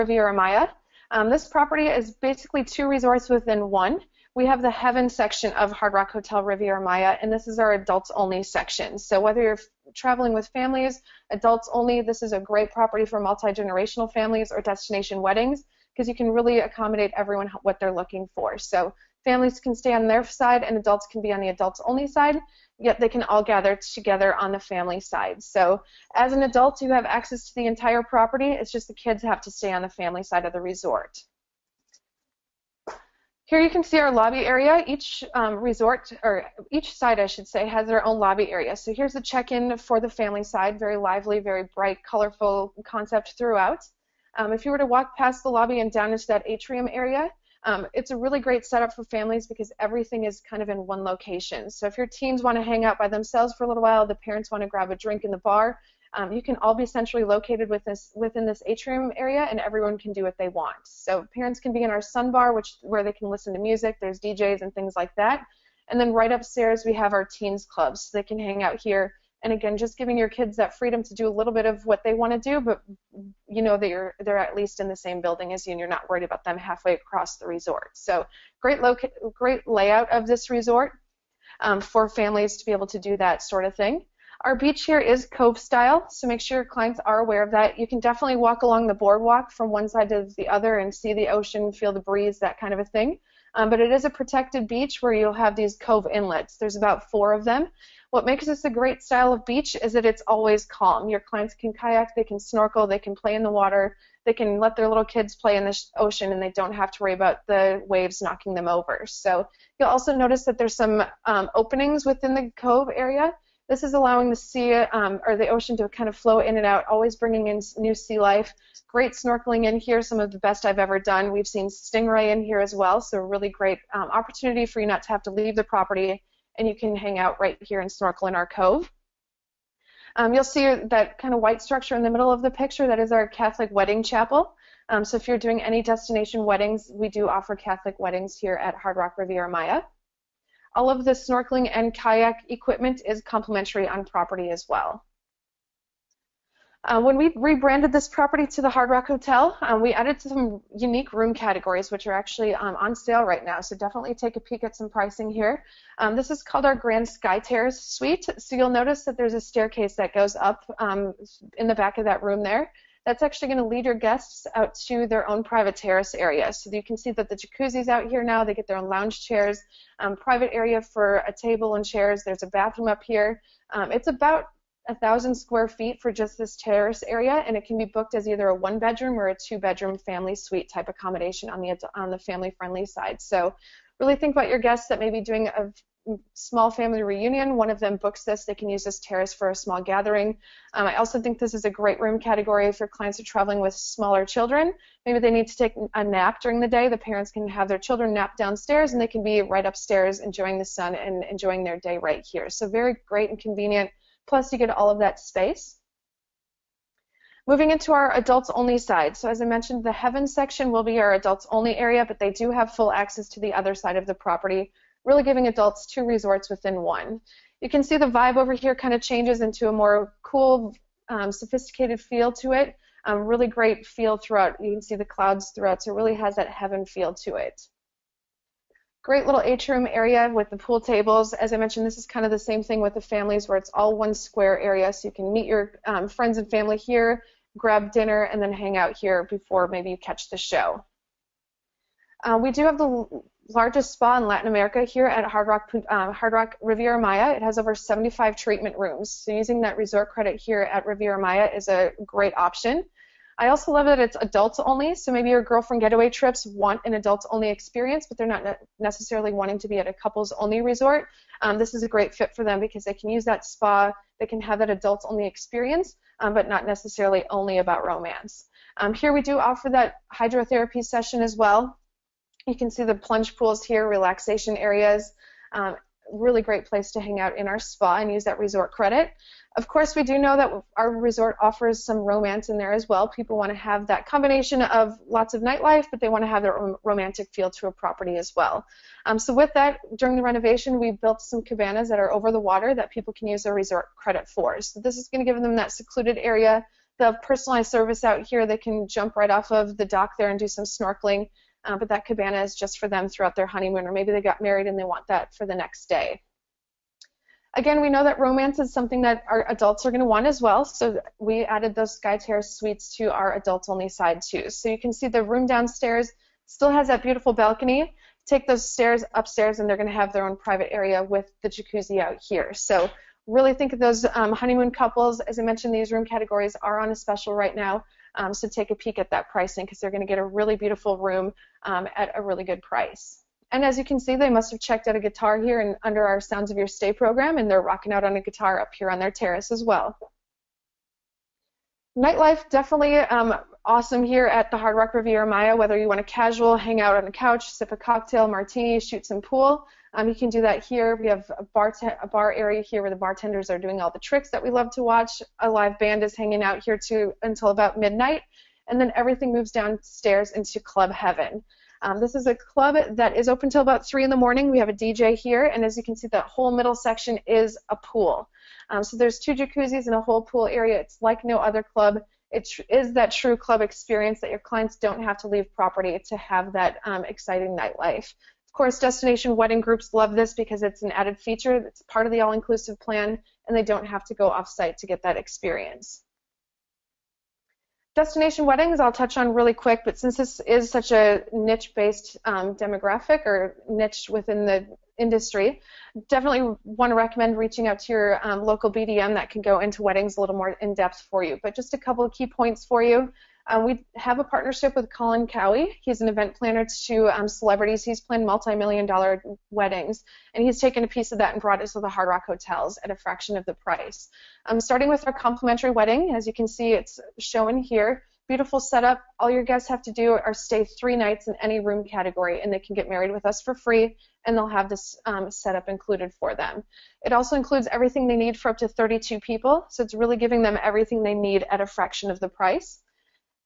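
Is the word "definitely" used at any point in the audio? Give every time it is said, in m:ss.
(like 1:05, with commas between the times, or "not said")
1:27, 2:33, 5:42, 6:36.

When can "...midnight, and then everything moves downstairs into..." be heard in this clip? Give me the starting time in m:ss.
5:57.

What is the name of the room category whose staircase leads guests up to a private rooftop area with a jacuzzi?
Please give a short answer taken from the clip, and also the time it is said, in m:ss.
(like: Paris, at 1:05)
Grand Sky Terrace Suite, at 2:36.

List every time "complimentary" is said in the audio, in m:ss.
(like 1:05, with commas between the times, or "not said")
2:23, 6:55.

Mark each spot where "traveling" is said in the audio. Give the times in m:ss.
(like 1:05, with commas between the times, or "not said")
0:09, 3:13.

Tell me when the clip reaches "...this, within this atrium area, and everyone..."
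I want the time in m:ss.
0:57.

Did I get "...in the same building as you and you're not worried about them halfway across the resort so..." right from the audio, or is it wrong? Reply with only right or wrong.
right.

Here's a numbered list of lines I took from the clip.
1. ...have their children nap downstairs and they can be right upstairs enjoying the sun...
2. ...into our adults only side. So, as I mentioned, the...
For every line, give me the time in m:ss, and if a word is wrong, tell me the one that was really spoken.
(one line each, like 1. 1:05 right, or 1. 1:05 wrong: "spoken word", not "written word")
1. 3:17 right
2. 3:27 right.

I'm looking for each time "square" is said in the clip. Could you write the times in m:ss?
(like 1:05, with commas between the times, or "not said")
2:55, 3:54.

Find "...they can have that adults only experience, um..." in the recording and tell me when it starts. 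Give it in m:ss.
4:24.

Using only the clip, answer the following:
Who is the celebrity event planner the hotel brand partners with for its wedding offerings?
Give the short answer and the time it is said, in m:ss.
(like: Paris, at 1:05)
Colin Cowie, at 6:44.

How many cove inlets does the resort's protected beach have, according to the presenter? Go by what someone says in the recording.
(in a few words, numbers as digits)
4.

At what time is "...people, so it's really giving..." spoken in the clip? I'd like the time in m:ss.
7:09.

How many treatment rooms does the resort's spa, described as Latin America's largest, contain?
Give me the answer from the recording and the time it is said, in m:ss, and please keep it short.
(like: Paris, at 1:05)
Over 75, at 4:07.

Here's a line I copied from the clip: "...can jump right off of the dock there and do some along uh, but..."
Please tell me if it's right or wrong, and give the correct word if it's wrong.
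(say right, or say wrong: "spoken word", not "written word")
wrong: "snorkeling", not "along".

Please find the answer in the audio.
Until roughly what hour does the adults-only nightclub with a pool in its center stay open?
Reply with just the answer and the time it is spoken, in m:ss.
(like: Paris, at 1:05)
3 a.m., at 6:03.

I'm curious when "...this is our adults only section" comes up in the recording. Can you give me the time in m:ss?
0:07.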